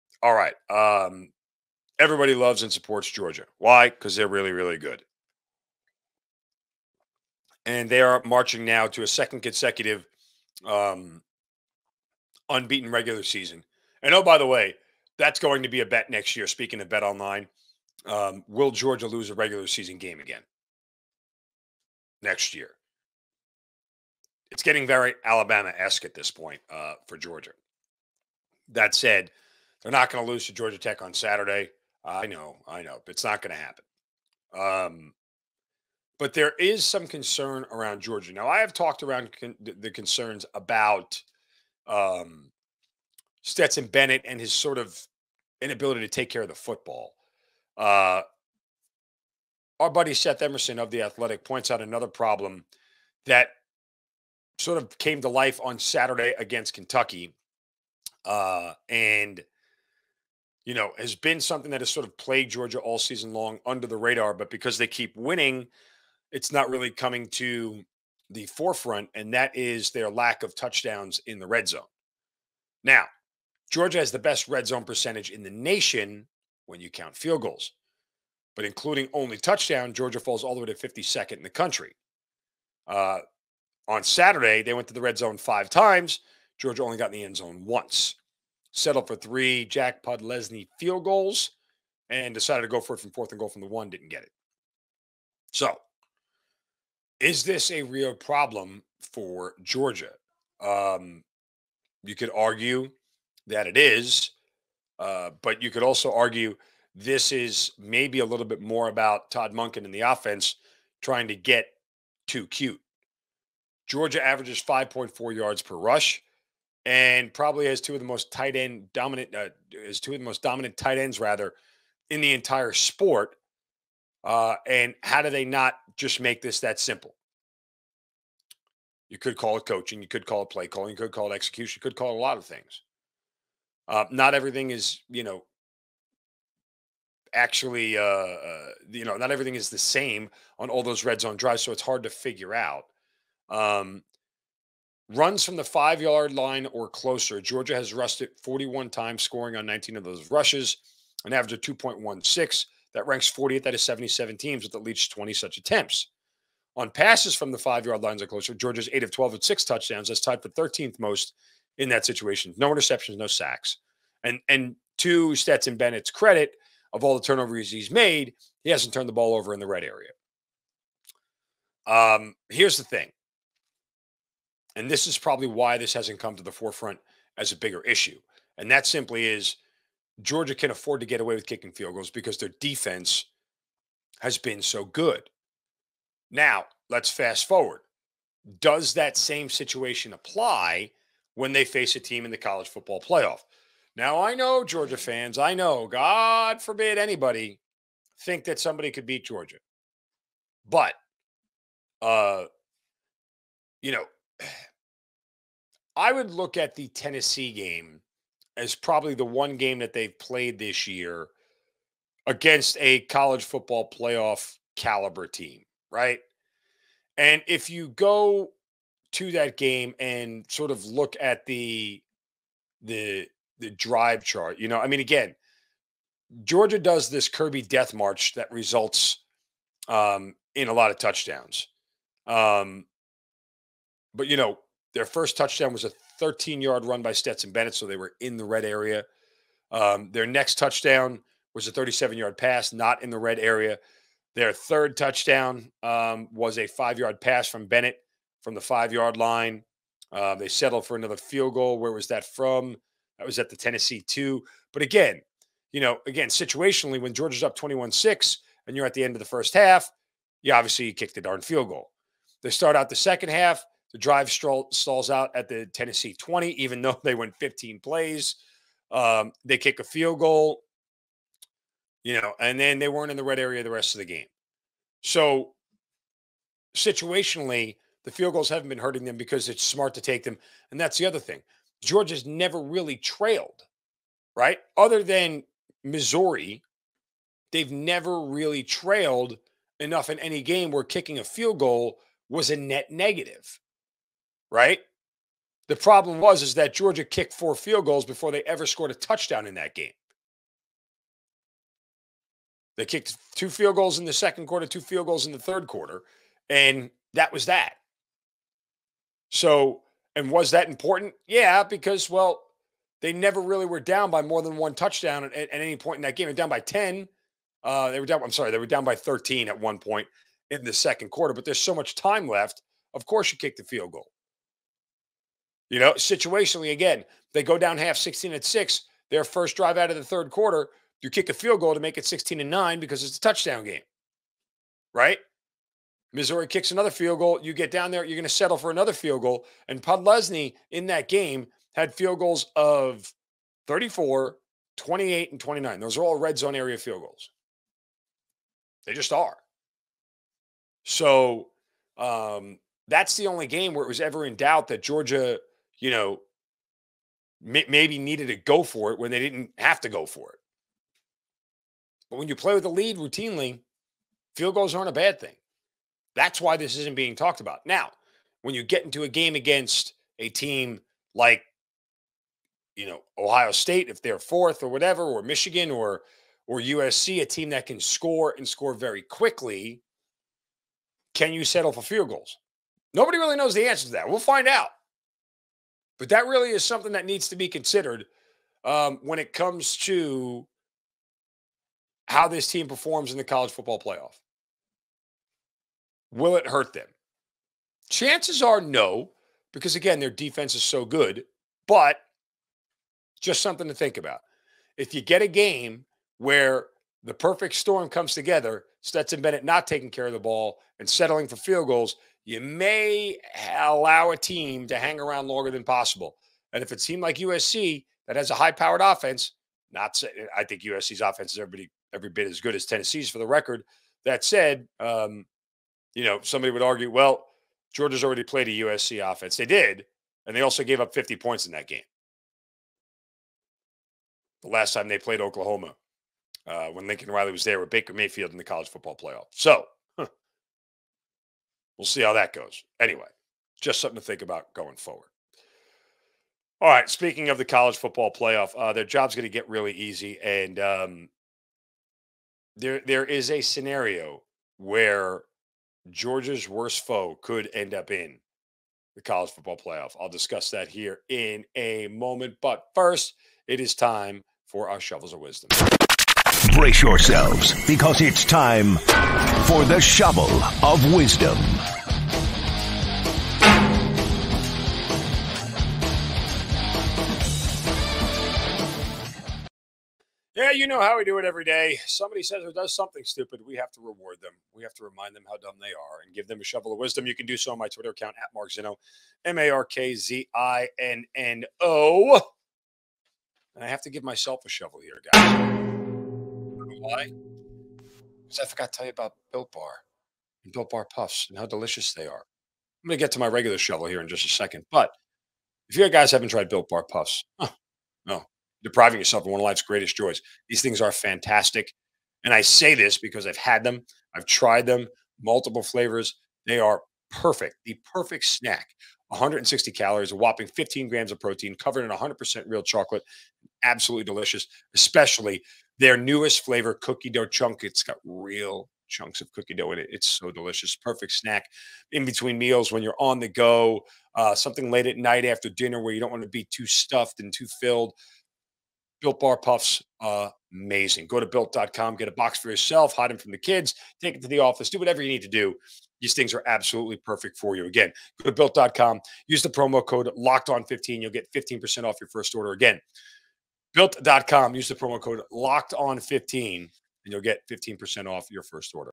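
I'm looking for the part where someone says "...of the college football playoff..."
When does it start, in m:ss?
7:27.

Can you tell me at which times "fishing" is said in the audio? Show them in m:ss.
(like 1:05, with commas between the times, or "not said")
not said.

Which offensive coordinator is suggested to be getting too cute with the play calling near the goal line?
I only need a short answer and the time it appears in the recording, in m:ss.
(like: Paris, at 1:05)
Todd Monken, at 1:49.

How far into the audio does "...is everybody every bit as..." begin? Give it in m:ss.
7:01.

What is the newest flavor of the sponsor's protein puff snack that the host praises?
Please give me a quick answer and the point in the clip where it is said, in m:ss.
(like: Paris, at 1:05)
cookie dough chunk, at 8:46.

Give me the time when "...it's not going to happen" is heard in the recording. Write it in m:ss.
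0:33.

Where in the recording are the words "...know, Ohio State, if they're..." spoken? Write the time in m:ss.
6:12.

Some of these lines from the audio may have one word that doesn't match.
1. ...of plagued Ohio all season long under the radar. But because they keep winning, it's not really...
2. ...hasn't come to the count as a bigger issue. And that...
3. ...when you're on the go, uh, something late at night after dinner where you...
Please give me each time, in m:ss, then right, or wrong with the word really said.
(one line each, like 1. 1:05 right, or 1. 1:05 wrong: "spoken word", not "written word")
1. 1:02 wrong: "Georgia", not "Ohio"
2. 2:55 wrong: "forefront", not "count"
3. 8:52 right.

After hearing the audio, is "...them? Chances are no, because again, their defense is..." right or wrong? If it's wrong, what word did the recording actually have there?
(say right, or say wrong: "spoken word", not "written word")
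right.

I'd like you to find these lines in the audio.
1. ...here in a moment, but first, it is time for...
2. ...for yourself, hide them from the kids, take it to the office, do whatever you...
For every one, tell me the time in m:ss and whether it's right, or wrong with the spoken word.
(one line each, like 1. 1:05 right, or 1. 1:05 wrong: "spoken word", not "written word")
1. 7:40 right
2. 9:02 right.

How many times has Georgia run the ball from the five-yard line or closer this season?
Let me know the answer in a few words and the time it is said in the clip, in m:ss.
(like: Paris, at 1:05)
41, at 2:28.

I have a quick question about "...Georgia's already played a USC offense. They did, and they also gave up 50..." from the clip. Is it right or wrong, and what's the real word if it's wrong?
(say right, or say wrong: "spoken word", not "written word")
right.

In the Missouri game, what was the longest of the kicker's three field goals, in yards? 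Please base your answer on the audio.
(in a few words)
34.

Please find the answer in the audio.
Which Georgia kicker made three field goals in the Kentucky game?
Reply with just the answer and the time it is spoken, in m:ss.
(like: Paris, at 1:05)
Jack Podlesny, at 1:29.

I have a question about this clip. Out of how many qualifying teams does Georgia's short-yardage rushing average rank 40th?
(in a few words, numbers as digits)
77.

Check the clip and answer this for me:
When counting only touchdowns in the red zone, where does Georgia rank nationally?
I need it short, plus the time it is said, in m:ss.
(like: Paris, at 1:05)
52nd, at 1:20.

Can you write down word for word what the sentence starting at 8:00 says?
Yeah, you know how we do it every day.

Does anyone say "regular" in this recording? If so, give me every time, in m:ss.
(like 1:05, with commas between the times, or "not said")
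0:12, 0:19, 8:23.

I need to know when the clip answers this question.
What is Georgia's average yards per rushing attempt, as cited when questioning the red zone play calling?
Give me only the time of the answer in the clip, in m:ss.
1:54.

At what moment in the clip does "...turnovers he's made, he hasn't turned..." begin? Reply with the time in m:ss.
2:47.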